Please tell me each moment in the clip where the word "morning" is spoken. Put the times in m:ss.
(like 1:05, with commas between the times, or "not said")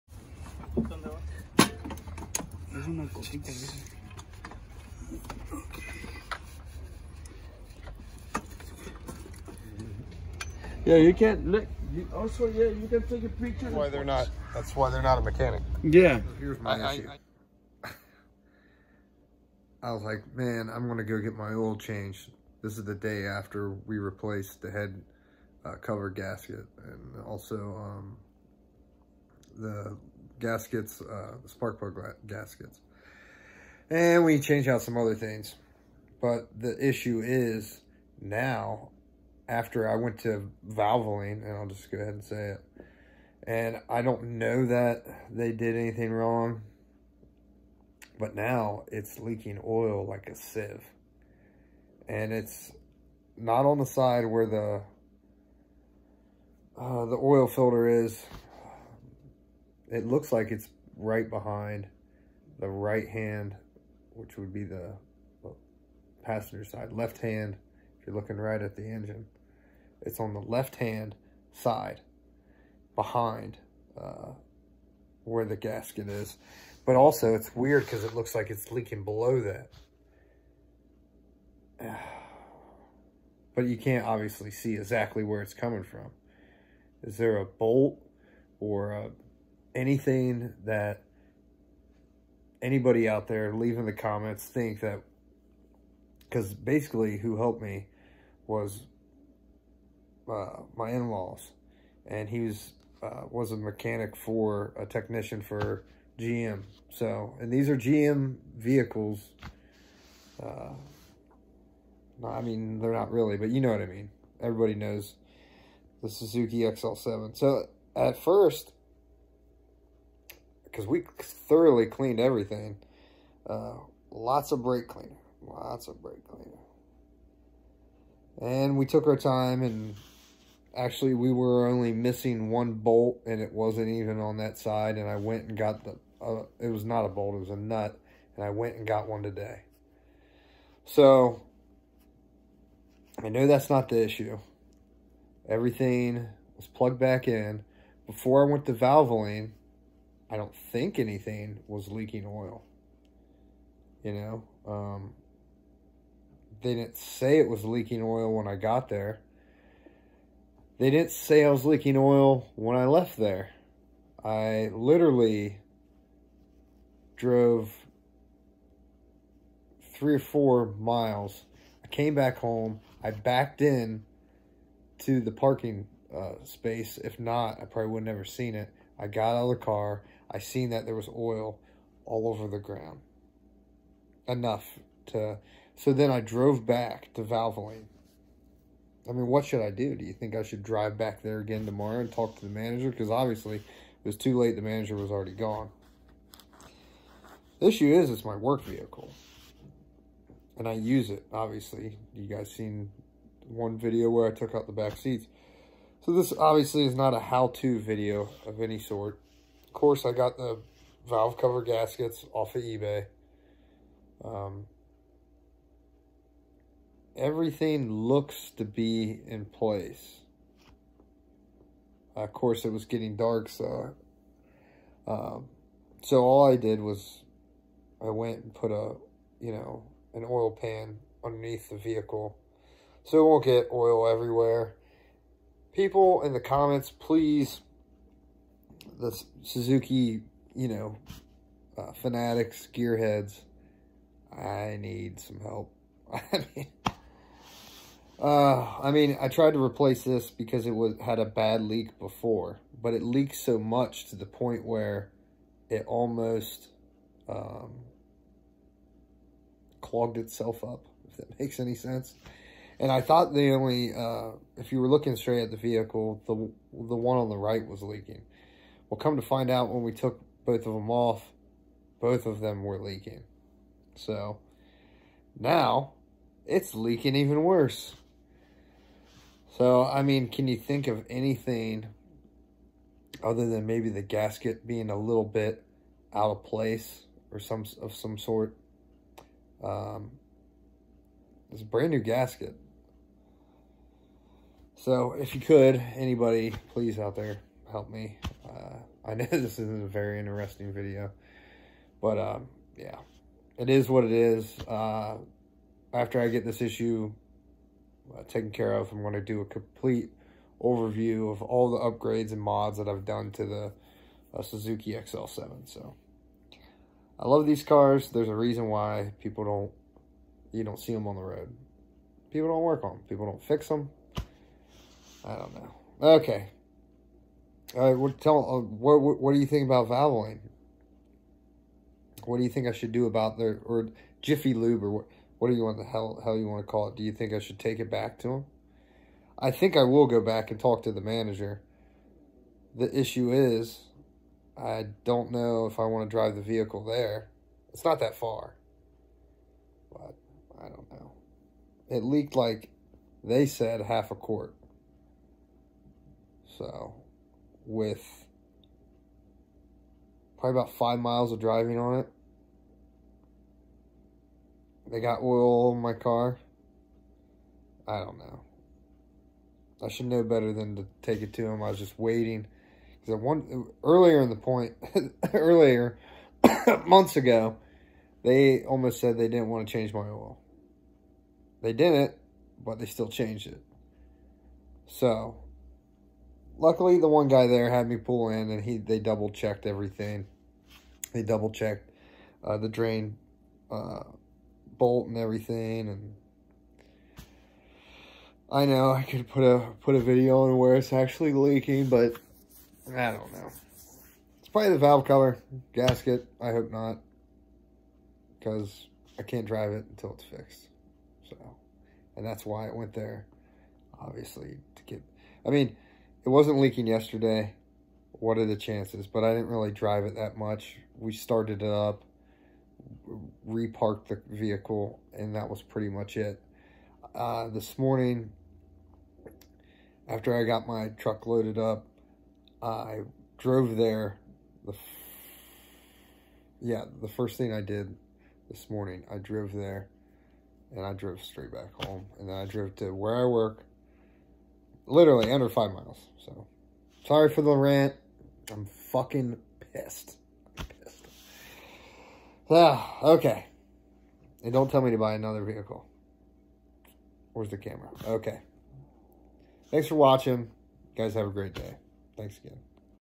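7:07, 7:18.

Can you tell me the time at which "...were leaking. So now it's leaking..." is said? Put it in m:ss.
4:32.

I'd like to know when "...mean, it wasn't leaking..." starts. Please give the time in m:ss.
6:55.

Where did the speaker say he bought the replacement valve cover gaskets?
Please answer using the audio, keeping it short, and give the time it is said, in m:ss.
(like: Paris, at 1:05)
eBay, at 3:32.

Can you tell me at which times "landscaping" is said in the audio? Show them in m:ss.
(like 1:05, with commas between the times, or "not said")
not said.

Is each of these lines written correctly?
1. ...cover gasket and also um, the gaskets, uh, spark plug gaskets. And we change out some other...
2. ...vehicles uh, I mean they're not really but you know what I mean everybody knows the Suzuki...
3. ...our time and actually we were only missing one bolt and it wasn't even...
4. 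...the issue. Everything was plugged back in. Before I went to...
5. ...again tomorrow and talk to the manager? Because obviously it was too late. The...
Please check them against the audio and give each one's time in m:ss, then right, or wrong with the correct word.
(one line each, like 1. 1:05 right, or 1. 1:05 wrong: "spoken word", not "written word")
1. 0:25 right
2. 1:48 right
3. 2:09 right
4. 2:23 right
5. 3:11 right.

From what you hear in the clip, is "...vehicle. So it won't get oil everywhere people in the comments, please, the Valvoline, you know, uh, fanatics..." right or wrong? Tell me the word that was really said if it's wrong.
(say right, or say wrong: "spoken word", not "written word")
wrong: "Suzuki", not "Valvoline".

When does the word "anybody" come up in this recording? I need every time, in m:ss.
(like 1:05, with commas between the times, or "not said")
1:32, 4:55.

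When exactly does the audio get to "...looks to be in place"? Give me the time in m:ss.
3:37.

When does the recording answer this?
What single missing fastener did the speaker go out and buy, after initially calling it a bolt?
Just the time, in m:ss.
2:17.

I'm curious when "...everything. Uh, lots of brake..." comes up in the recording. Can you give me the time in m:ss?
2:02.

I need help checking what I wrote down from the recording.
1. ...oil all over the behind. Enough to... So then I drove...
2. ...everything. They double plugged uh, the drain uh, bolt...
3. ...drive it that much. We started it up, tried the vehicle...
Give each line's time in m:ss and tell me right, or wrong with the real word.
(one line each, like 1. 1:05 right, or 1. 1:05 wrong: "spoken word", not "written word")
1. 3:01 wrong: "ground", not "behind"
2. 6:29 wrong: "checked", not "plugged"
3. 6:59 wrong: "reparked", not "tried".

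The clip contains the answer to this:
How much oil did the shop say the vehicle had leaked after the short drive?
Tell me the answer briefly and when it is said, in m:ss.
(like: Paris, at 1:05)
half a quart, at 5:53.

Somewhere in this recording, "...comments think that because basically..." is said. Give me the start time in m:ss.
1:33.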